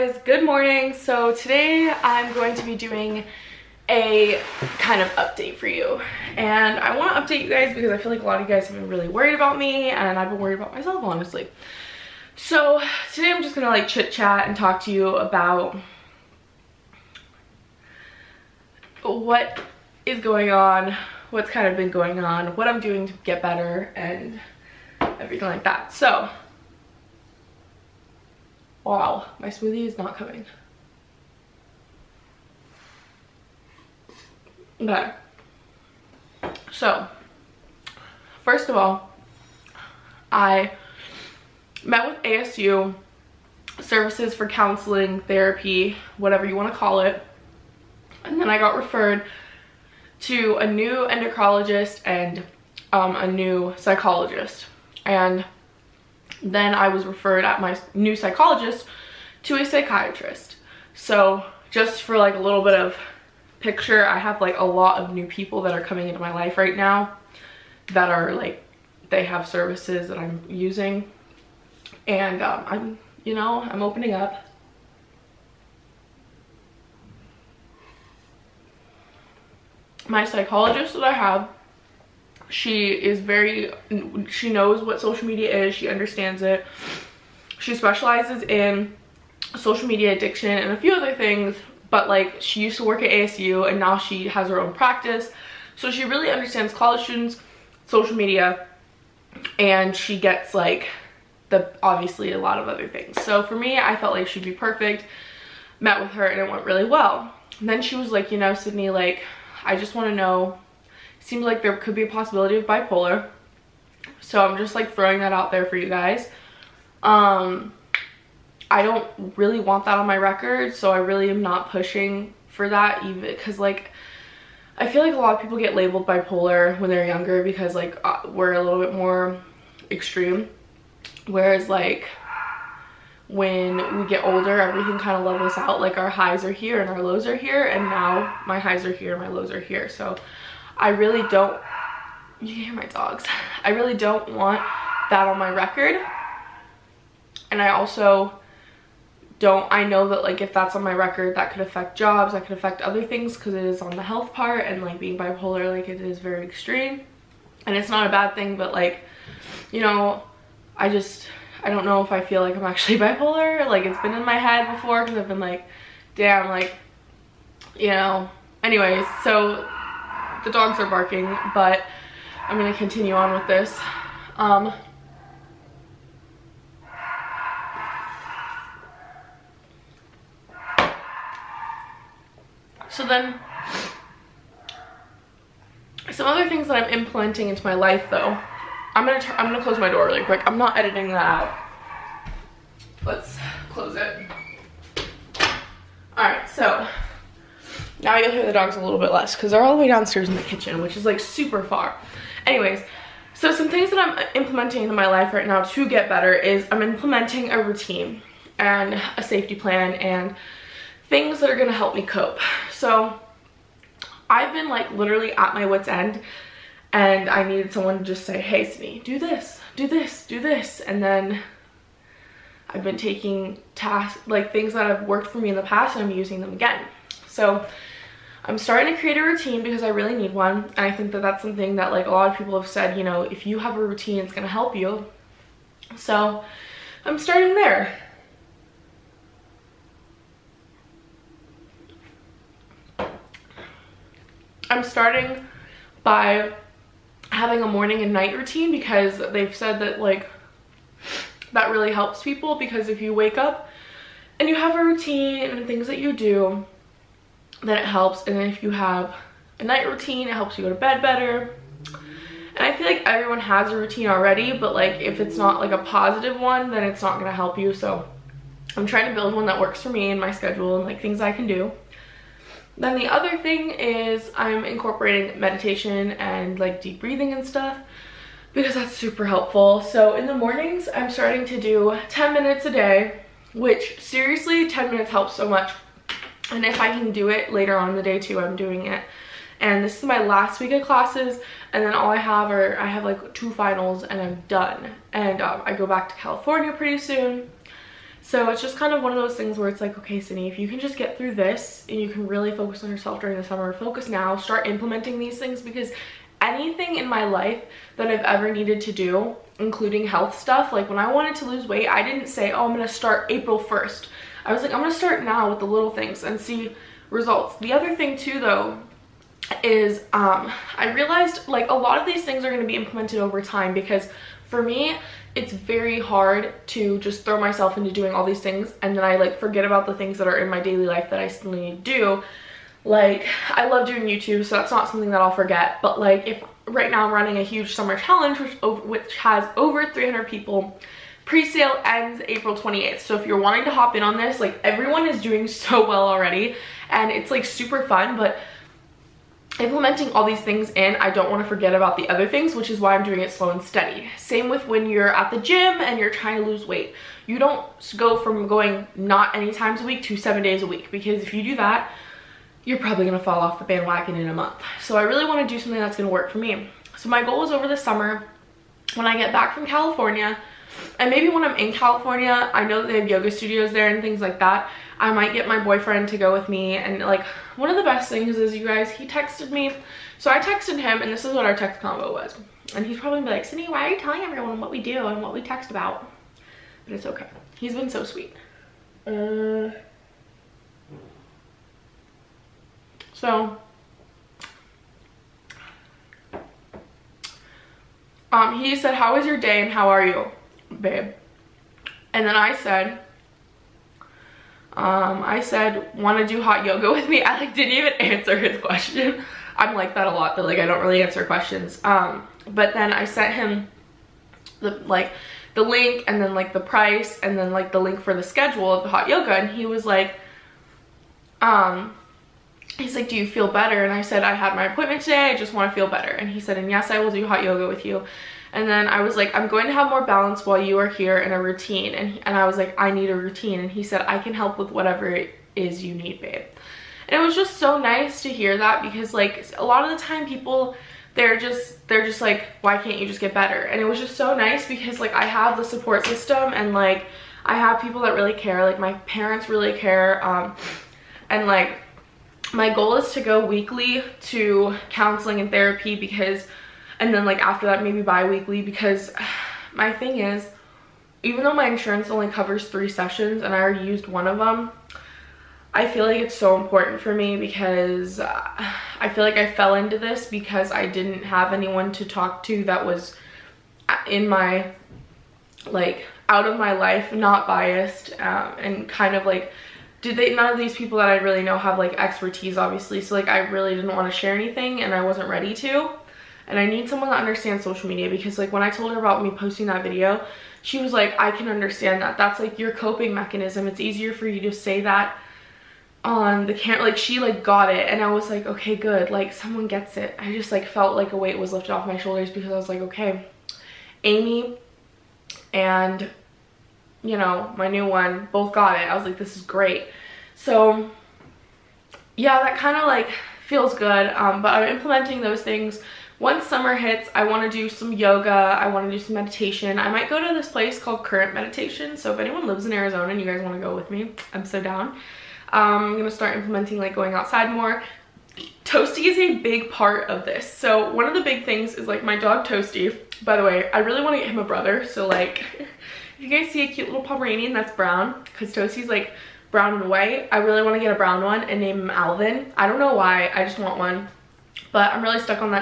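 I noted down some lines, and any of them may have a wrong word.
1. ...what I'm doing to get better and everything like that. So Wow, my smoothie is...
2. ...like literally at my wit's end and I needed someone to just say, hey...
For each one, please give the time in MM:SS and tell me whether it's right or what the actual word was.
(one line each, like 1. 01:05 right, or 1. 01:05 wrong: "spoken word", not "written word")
1. 00:22 right
2. 03:34 right.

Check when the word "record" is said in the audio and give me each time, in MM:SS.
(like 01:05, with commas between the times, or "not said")
02:00, 02:25, 02:30.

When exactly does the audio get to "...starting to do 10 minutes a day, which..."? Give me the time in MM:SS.
04:41.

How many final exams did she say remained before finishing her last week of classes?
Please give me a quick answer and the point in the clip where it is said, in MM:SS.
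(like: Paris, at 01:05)
2, at 04:53.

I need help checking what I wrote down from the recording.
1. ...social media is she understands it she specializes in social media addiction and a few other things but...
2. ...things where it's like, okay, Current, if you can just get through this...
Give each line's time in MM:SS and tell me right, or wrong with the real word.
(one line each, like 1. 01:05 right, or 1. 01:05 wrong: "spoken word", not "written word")
1. 01:25 right
2. 04:59 wrong: "Sidney", not "Current".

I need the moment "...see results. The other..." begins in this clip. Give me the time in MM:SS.
05:16.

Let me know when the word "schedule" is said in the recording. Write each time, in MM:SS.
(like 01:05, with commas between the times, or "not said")
04:30, 06:58.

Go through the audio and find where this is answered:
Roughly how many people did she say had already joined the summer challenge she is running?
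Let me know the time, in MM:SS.
05:39.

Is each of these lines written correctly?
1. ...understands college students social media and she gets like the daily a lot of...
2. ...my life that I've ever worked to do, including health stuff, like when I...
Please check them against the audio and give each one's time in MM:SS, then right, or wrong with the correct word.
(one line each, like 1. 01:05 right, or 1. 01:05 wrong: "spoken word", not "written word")
1. 01:36 wrong: "obviously", not "daily"
2. 05:07 wrong: "needed", not "worked".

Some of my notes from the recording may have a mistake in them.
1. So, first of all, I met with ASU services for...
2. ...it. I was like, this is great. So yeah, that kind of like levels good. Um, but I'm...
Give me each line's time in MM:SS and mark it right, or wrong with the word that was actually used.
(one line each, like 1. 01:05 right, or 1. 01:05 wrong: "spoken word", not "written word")
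1. 00:36 right
2. 08:28 wrong: "feels", not "levels".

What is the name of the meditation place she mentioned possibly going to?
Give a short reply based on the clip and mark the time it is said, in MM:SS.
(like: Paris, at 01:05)
Current Meditation, at 08:41.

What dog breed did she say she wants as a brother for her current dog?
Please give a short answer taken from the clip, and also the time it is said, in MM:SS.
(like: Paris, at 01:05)
Pomeranian, at 08:57.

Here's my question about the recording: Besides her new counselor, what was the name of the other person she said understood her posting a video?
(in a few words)
Amy.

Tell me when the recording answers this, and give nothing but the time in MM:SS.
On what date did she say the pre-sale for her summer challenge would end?
05:42.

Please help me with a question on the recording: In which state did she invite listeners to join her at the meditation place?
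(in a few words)
Arizona.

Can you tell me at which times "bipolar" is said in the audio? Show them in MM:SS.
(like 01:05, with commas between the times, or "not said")
01:52, 02:06, 02:35, 02:42.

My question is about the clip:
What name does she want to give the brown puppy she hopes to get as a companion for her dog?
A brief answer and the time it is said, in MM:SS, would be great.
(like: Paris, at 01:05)
Alvin, at 09:01.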